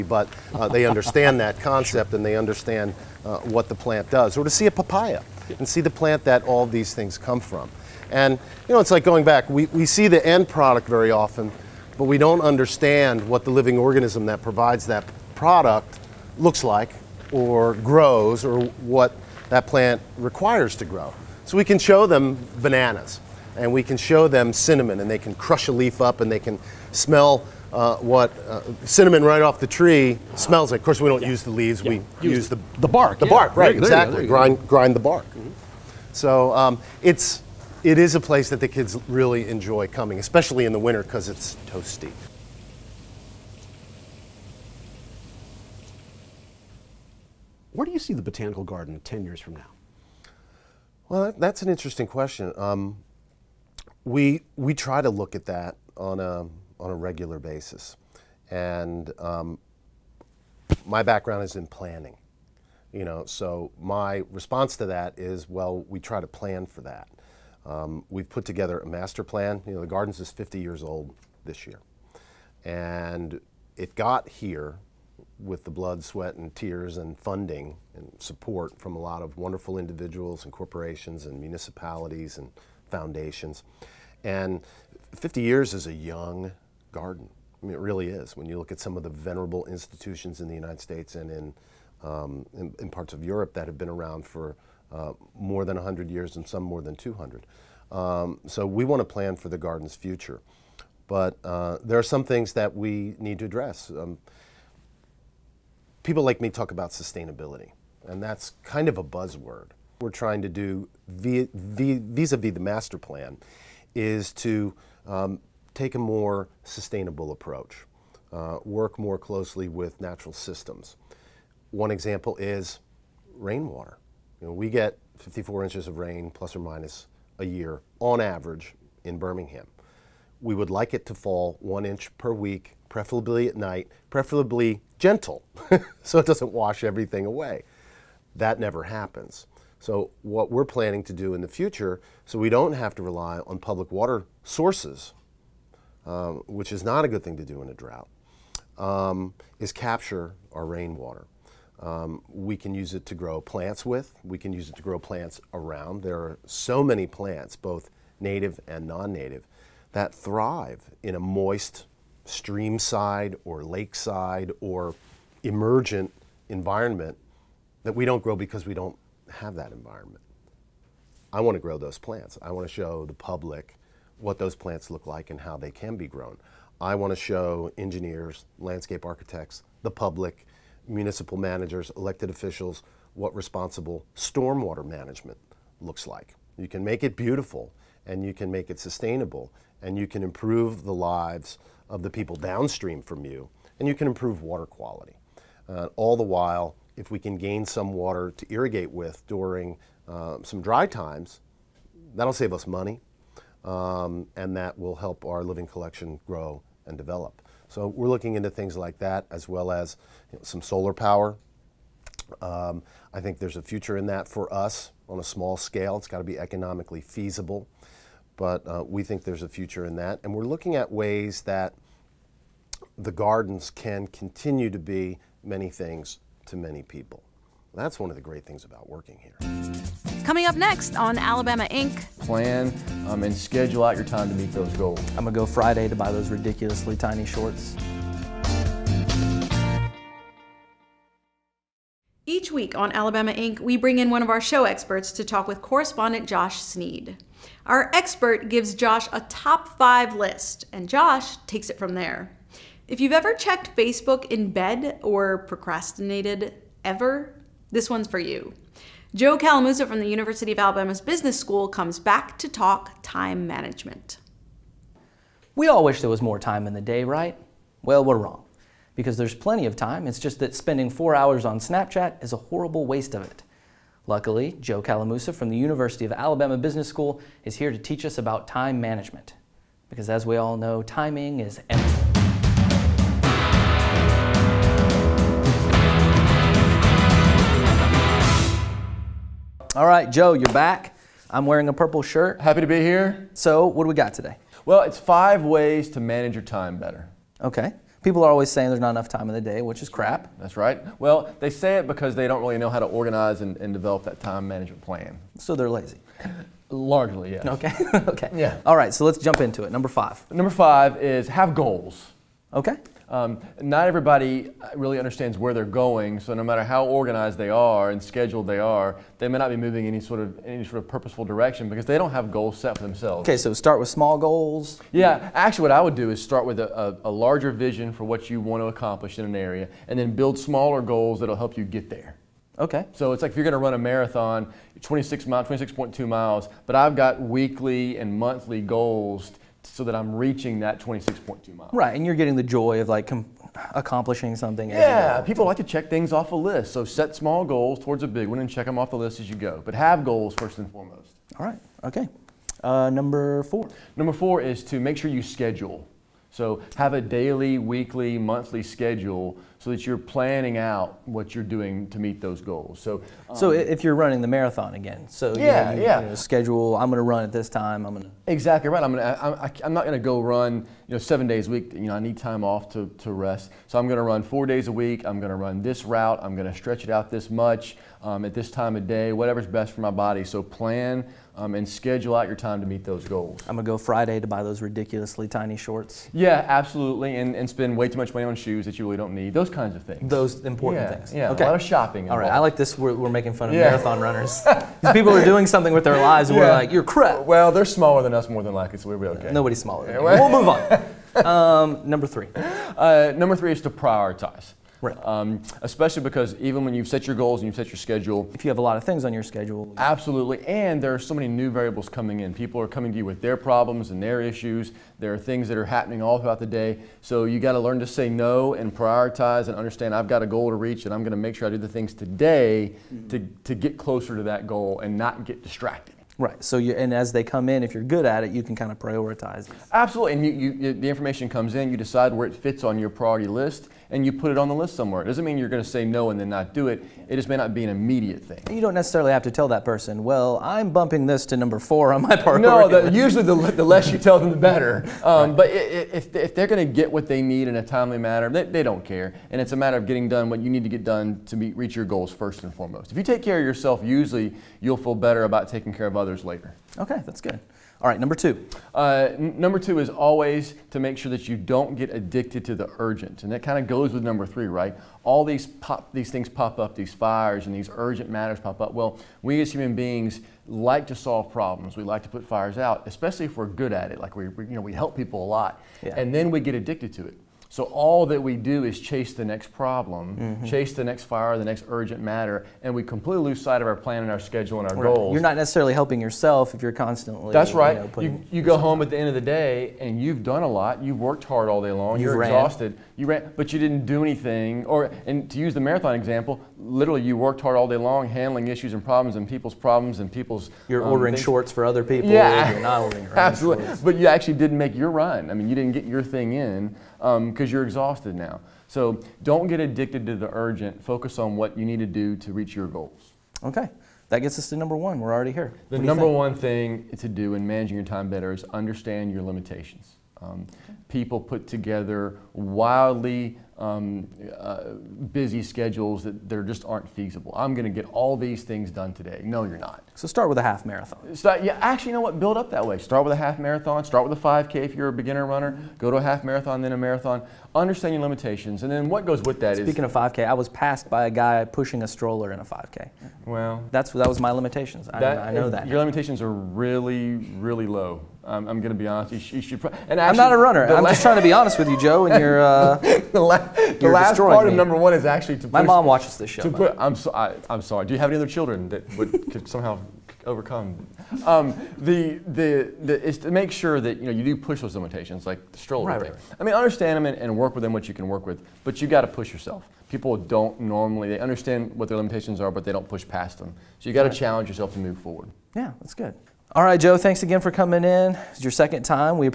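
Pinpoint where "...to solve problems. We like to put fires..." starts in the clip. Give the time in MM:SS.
07:50.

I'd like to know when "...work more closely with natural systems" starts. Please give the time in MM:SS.
01:58.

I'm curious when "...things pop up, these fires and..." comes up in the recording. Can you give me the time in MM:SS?
07:46.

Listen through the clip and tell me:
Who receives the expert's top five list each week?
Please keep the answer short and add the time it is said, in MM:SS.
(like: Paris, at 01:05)
Josh Snead, at 04:06.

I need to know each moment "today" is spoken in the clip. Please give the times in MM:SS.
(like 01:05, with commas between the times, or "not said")
04:54, 07:01, 08:48.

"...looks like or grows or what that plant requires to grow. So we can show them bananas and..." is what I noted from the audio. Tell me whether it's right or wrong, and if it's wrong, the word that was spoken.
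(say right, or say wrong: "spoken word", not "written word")
right.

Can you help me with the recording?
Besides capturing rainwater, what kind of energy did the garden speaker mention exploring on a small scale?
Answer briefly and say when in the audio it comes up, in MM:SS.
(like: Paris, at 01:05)
solar power, at 03:30.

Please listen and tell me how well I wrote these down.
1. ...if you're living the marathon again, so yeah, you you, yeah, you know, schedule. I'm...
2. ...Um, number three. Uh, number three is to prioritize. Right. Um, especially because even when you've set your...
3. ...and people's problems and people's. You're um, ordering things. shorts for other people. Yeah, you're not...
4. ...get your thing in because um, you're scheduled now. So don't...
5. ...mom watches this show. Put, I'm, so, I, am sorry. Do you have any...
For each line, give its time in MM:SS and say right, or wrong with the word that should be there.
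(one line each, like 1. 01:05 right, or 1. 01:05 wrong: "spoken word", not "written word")
1. 06:03 wrong: "running", not "living"
2. 06:41 right
3. 08:19 right
4. 08:25 wrong: "exhausted", not "scheduled"
5. 09:15 right.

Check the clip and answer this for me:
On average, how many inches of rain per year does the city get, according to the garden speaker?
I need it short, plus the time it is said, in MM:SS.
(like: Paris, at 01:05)
54 inches, at 02:05.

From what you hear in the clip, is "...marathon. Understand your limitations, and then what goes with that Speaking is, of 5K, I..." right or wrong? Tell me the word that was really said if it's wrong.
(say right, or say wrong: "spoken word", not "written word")
right.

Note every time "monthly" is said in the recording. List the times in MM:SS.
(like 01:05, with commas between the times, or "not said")
05:38, 05:58.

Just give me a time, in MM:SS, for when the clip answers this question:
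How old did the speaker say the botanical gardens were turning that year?
01:09.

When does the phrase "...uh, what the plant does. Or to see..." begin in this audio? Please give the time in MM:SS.
00:03.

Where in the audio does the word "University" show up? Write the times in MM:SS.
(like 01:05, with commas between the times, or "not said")
04:20, 04:35.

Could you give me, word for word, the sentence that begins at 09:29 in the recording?
People don't normally they understand what their limitations are, but they don't push past them.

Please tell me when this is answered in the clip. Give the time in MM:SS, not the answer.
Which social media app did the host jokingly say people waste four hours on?
04:31.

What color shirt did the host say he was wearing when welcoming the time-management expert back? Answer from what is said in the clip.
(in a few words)
purple.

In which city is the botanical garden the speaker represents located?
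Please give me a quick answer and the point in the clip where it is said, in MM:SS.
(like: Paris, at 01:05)
Birmingham, at 02:09.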